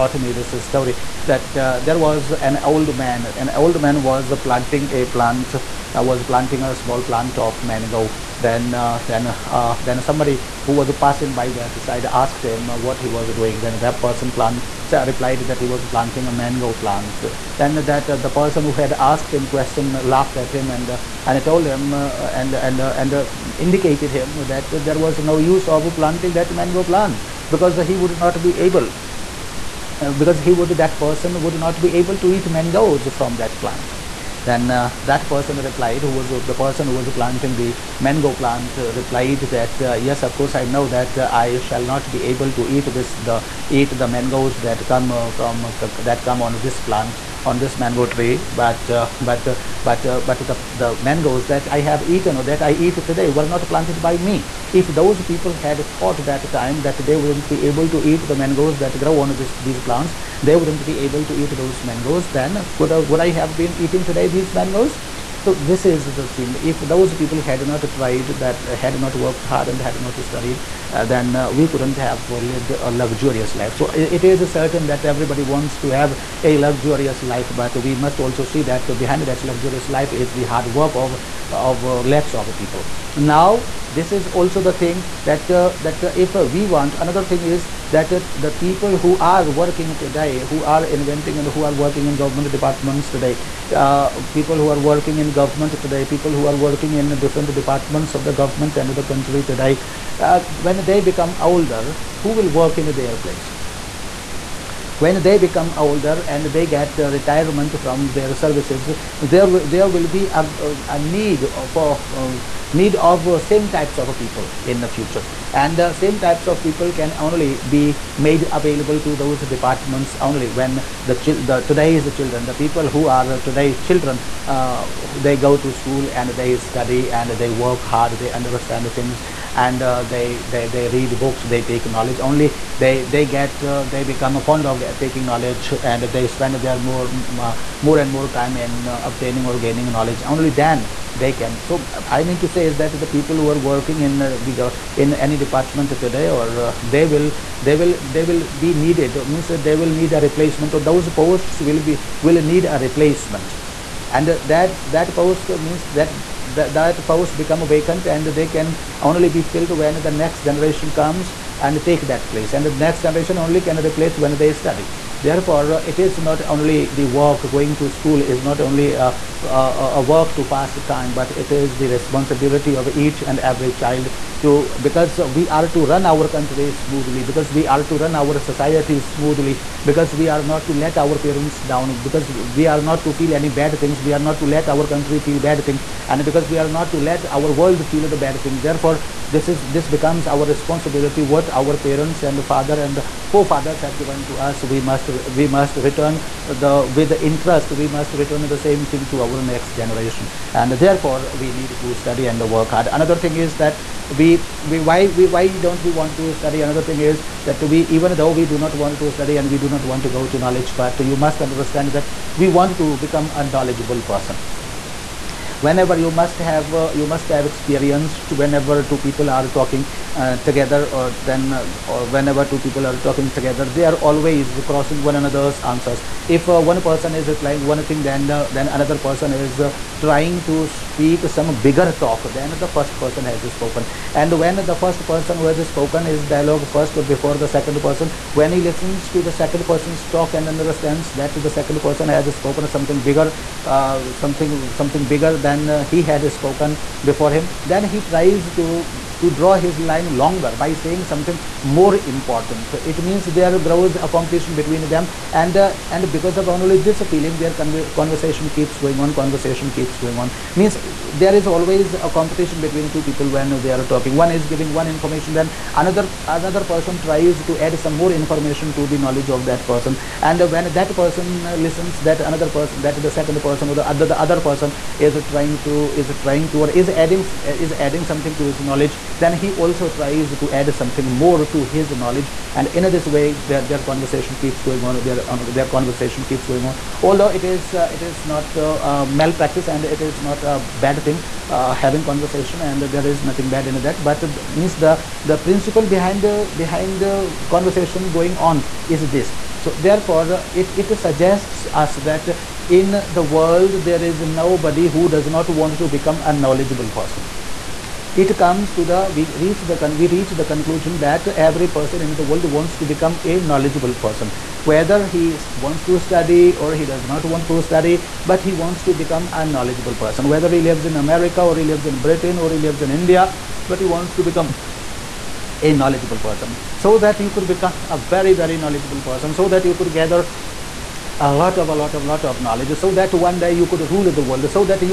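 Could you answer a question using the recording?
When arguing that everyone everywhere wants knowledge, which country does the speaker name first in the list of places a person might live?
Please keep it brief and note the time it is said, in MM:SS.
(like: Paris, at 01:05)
America, at 05:21.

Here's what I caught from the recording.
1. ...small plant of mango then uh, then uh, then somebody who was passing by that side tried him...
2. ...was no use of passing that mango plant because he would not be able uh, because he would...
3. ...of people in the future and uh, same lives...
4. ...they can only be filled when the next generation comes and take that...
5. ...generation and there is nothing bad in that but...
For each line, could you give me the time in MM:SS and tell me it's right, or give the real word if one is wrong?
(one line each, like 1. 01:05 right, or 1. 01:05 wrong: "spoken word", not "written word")
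1. 00:06 wrong: "asked", not "tried"
2. 00:24 wrong: "planting", not "passing"
3. 01:53 wrong: "types", not "lives"
4. 02:38 right
5. 04:52 wrong: "conversation", not "generation".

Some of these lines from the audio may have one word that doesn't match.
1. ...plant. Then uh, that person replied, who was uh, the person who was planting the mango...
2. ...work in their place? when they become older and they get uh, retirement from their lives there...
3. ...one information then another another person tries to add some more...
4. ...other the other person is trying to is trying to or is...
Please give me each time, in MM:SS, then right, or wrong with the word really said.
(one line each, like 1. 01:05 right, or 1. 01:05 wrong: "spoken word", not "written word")
1. 00:33 right
2. 01:42 wrong: "services", not "lives"
3. 04:24 right
4. 04:33 right.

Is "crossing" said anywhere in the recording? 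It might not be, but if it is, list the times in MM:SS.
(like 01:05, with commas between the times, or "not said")
03:44.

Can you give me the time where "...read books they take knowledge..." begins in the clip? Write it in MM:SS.
02:10.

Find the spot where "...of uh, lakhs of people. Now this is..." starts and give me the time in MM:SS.
01:21.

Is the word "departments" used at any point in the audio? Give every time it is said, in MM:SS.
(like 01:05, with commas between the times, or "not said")
01:32, 01:37, 01:59, 02:25.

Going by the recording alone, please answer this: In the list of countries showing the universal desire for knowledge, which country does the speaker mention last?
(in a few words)
India.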